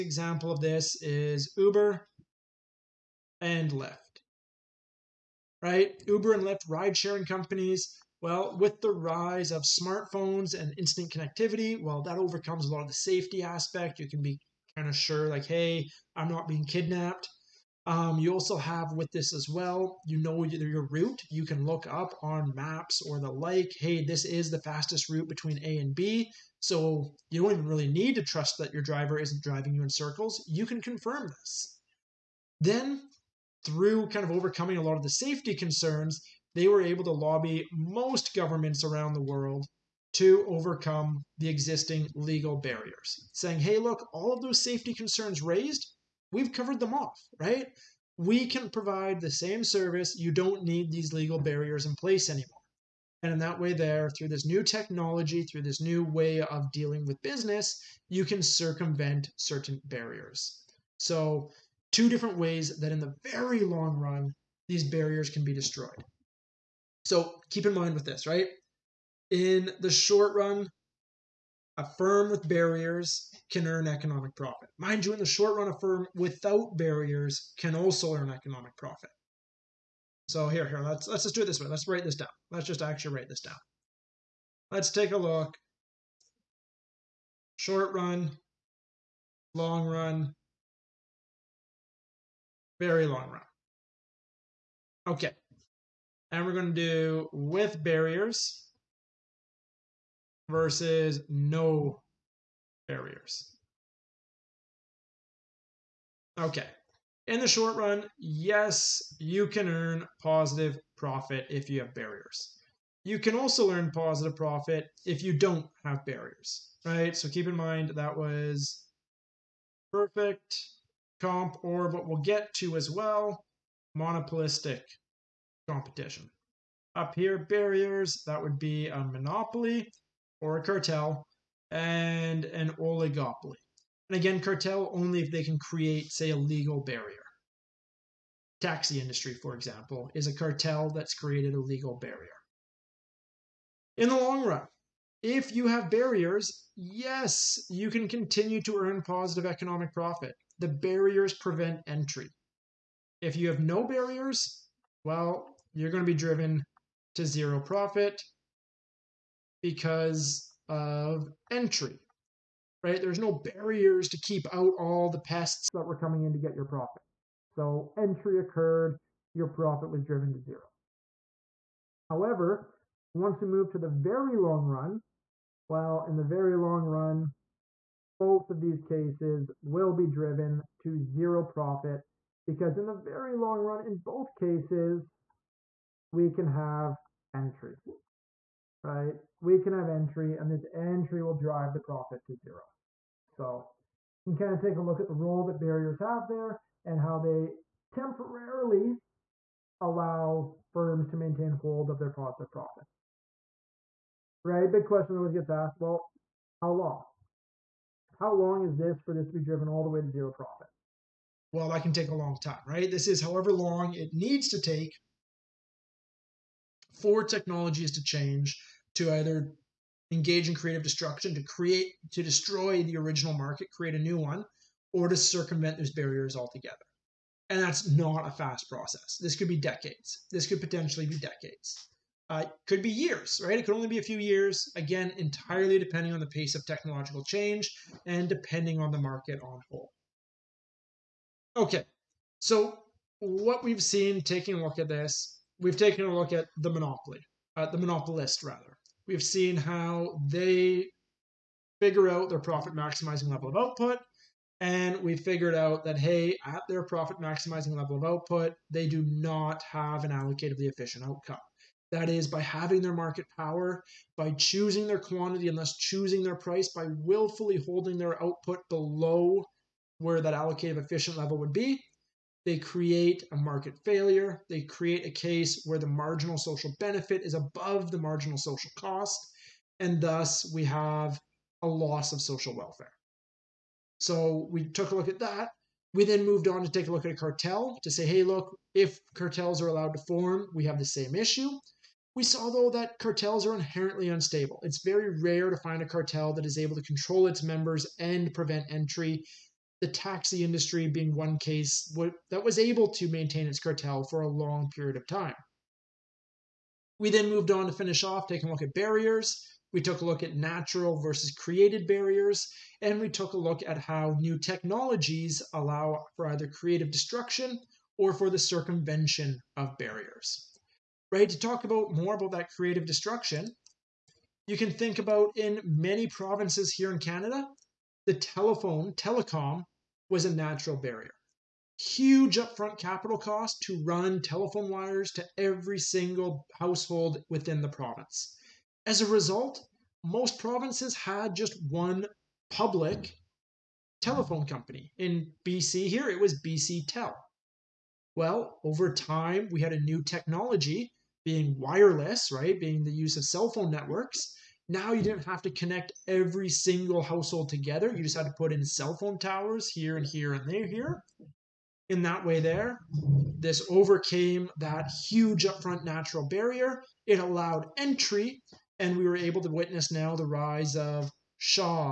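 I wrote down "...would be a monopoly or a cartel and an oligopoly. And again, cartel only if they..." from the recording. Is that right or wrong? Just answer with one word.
right.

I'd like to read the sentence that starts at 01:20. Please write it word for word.
So here, here, let's let's just do it this way.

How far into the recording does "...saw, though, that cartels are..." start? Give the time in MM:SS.
04:52.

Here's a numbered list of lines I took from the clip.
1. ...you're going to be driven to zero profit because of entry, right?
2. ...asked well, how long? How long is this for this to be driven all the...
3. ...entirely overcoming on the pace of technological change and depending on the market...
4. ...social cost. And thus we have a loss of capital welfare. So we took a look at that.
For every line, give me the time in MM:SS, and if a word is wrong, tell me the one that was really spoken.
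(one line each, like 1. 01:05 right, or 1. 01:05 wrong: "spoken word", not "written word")
1. 02:35 right
2. 03:25 right
3. 03:55 wrong: "depending", not "overcoming"
4. 04:38 wrong: "social", not "capital".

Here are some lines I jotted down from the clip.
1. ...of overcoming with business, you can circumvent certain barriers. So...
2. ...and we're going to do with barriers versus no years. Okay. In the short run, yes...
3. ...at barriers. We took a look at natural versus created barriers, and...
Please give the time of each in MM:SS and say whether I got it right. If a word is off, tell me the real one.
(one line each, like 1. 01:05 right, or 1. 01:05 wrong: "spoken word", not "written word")
1. 00:56 wrong: "dealing", not "overcoming"
2. 01:36 wrong: "barriers", not "years"
3. 05:08 right.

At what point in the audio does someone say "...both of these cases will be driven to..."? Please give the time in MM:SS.
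02:58.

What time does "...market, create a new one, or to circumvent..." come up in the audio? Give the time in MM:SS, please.
03:43.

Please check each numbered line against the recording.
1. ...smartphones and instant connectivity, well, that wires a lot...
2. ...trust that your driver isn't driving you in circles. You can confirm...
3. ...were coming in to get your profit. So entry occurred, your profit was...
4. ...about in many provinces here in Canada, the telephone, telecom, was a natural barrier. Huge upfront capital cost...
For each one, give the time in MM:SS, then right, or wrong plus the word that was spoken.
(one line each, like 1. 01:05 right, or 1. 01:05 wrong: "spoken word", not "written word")
1. 00:09 wrong: "overcomes", not "wires"
2. 00:28 right
3. 02:45 right
4. 05:24 right.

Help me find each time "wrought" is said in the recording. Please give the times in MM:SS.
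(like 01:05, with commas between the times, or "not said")
not said.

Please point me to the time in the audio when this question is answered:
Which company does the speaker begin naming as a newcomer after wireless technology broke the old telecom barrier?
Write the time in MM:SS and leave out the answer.
06:11.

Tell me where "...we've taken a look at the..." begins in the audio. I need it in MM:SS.
04:05.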